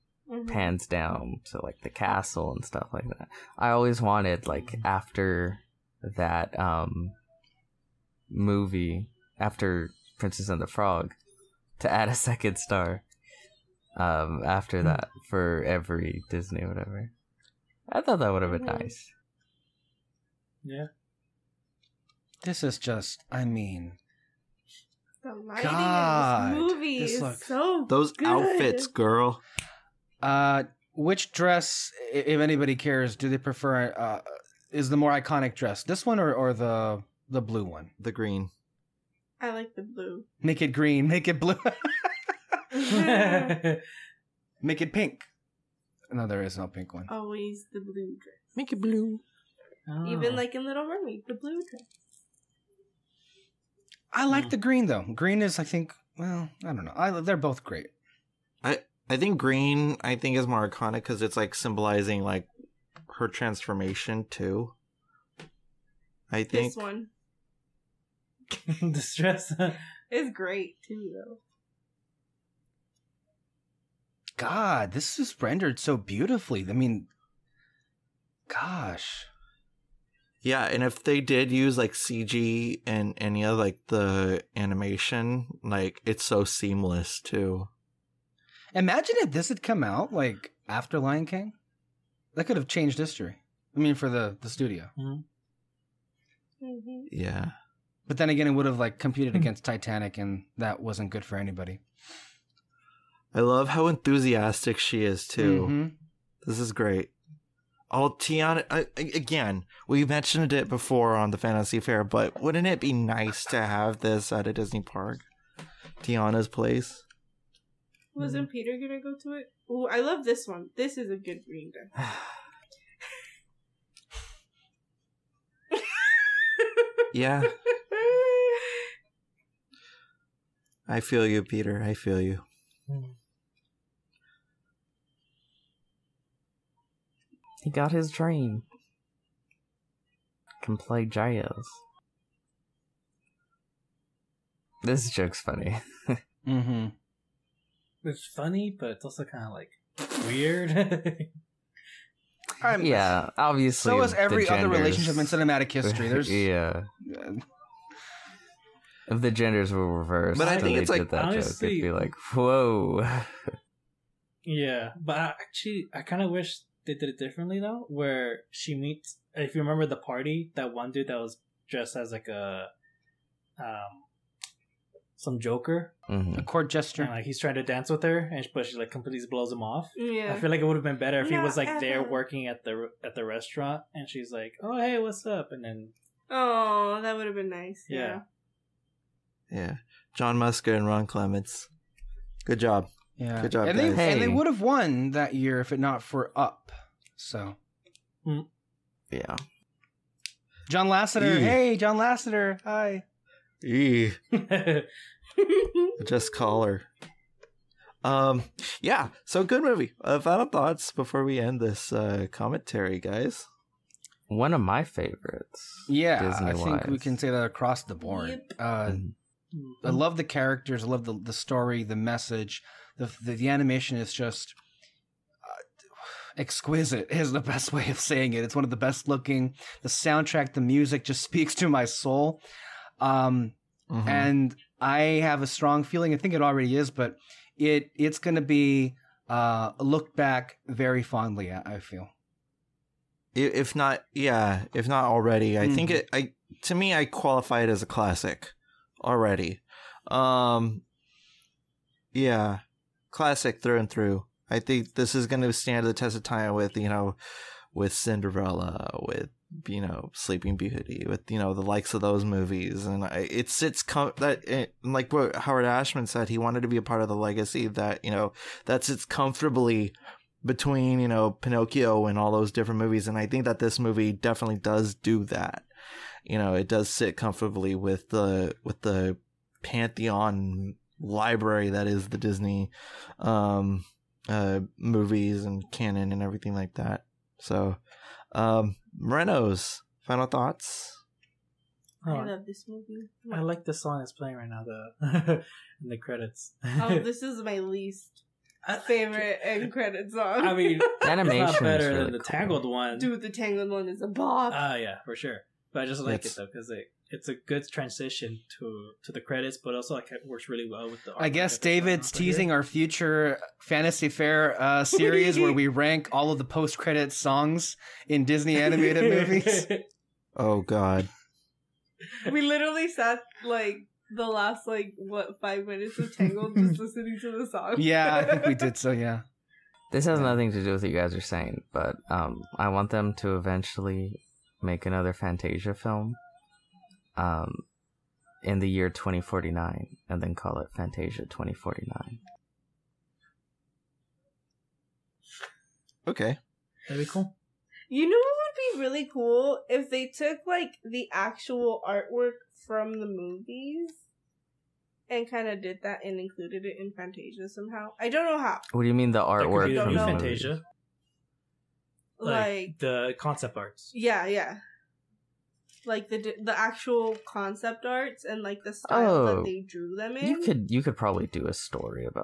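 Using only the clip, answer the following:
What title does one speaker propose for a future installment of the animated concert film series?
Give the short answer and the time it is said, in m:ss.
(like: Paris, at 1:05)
Fantasia 2049, at 5:40.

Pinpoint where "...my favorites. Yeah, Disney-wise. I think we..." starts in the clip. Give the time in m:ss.
3:34.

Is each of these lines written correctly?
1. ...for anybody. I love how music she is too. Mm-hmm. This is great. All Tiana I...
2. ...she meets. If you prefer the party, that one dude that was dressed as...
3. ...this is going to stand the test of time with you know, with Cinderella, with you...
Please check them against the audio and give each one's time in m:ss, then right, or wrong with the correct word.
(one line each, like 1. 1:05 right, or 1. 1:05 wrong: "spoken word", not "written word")
1. 1:41 wrong: "enthusiastic", not "music"
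2. 2:48 wrong: "remember", not "prefer"
3. 4:14 right.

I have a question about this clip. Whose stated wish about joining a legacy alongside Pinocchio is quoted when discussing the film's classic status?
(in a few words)
Howard Ashman.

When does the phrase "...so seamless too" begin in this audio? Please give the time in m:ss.
1:26.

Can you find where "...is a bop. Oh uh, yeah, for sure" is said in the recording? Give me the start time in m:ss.
5:03.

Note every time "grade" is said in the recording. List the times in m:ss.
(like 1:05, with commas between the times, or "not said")
not said.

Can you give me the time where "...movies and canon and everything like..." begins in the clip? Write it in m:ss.
4:44.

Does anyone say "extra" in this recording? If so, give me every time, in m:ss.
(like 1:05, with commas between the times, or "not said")
not said.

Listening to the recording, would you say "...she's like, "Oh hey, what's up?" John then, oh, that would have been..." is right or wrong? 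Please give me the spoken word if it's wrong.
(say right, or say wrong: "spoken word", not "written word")
wrong: "And", not "John".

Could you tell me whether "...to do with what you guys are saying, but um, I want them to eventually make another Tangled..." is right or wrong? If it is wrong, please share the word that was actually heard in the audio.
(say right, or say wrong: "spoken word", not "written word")
wrong: "Fantasia", not "Tangled".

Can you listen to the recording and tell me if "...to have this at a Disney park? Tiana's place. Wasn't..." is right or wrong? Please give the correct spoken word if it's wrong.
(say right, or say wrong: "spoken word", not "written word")
right.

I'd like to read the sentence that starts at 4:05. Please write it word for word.
think it i to me i qualify it as a classic already.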